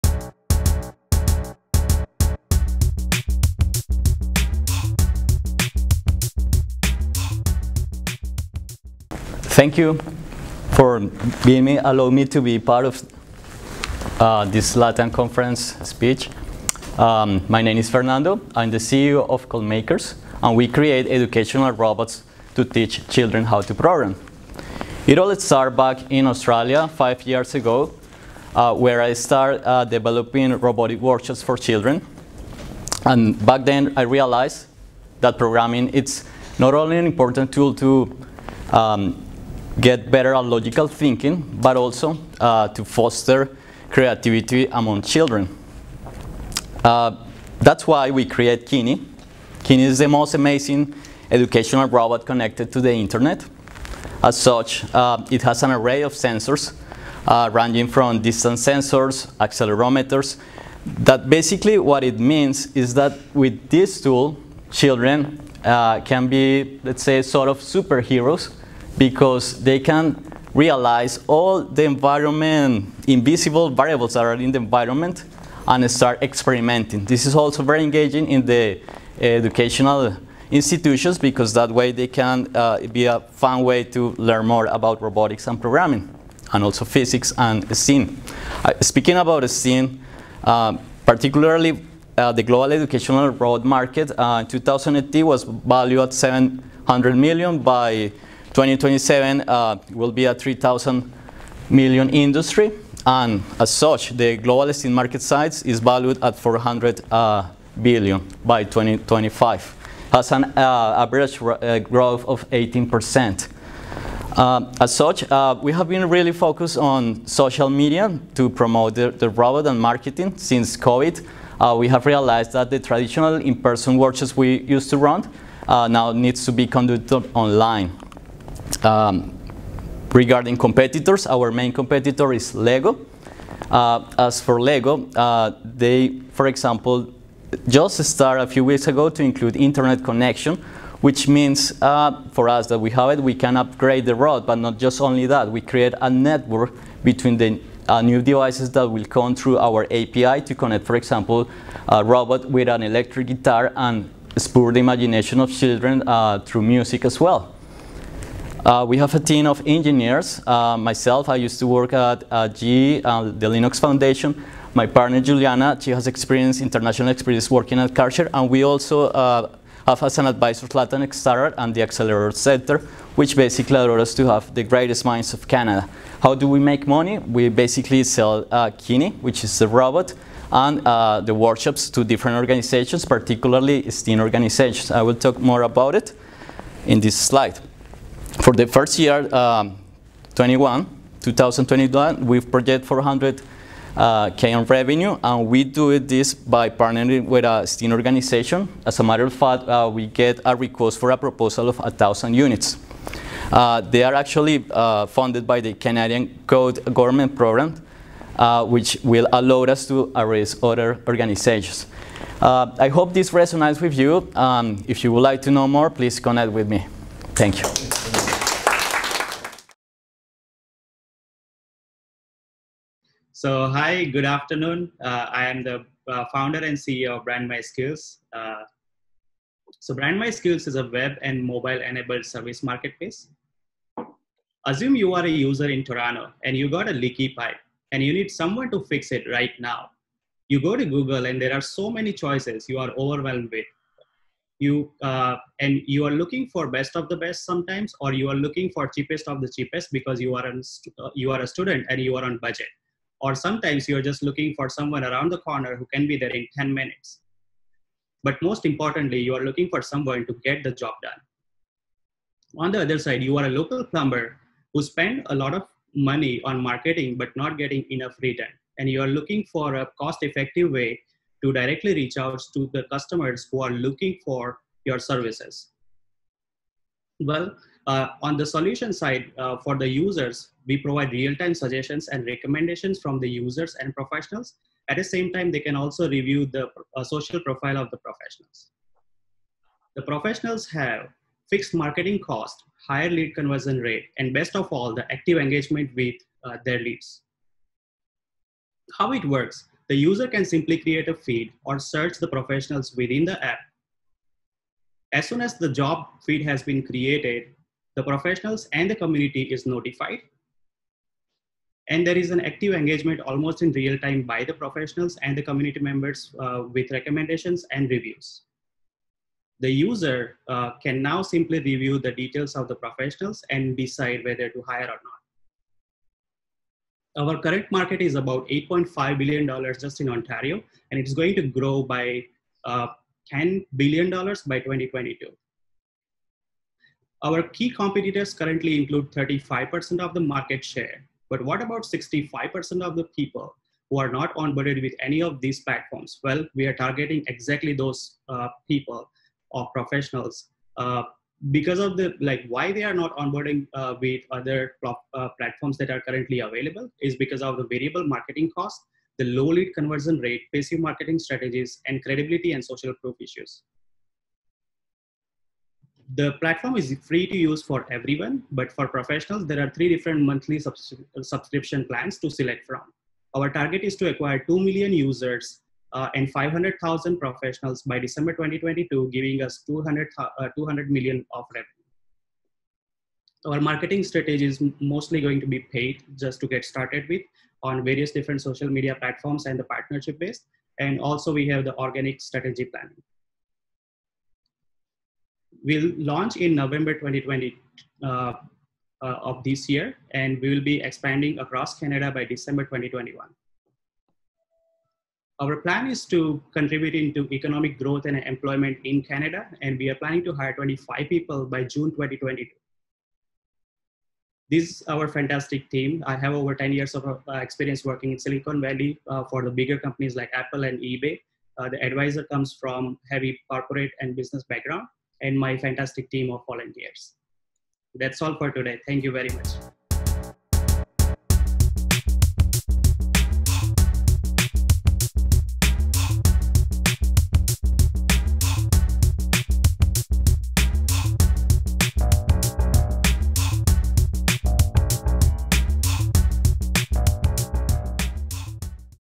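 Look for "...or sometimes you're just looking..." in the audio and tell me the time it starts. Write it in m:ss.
4:13.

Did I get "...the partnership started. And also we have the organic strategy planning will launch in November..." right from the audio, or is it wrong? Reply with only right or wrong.
wrong.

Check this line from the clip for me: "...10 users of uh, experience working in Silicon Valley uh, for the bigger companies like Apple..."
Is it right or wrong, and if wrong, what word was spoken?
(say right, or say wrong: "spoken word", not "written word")
wrong: "years", not "users".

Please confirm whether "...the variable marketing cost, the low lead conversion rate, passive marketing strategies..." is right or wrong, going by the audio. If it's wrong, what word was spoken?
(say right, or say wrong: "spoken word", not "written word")
right.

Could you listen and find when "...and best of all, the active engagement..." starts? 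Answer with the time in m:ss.
4:54.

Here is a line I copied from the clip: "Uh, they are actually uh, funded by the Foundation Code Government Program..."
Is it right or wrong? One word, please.
wrong.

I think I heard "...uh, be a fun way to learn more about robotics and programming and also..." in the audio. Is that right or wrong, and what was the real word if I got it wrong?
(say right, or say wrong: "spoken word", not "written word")
right.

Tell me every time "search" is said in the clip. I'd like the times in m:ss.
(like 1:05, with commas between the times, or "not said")
5:01.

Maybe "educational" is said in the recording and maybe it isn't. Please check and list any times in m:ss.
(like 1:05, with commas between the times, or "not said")
0:21, 0:51, 1:19, 1:32.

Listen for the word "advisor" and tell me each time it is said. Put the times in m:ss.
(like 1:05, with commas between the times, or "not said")
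2:50, 7:01.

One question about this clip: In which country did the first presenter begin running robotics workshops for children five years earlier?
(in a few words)
Australia.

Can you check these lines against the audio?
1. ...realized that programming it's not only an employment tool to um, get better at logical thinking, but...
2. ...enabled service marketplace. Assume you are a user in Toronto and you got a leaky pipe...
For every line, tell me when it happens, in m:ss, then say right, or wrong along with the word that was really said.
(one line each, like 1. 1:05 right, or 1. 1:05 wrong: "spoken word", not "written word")
1. 0:34 wrong: "important", not "employment"
2. 3:51 right.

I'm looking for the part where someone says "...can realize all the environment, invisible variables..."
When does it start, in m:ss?
1:09.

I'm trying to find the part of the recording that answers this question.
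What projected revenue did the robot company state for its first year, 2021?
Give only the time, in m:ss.
3:12.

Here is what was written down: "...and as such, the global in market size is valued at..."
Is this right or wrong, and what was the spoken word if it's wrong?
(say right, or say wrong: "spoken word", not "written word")
right.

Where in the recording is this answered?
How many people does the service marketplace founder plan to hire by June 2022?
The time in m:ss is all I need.
6:50.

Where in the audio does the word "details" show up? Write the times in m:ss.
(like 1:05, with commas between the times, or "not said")
5:22.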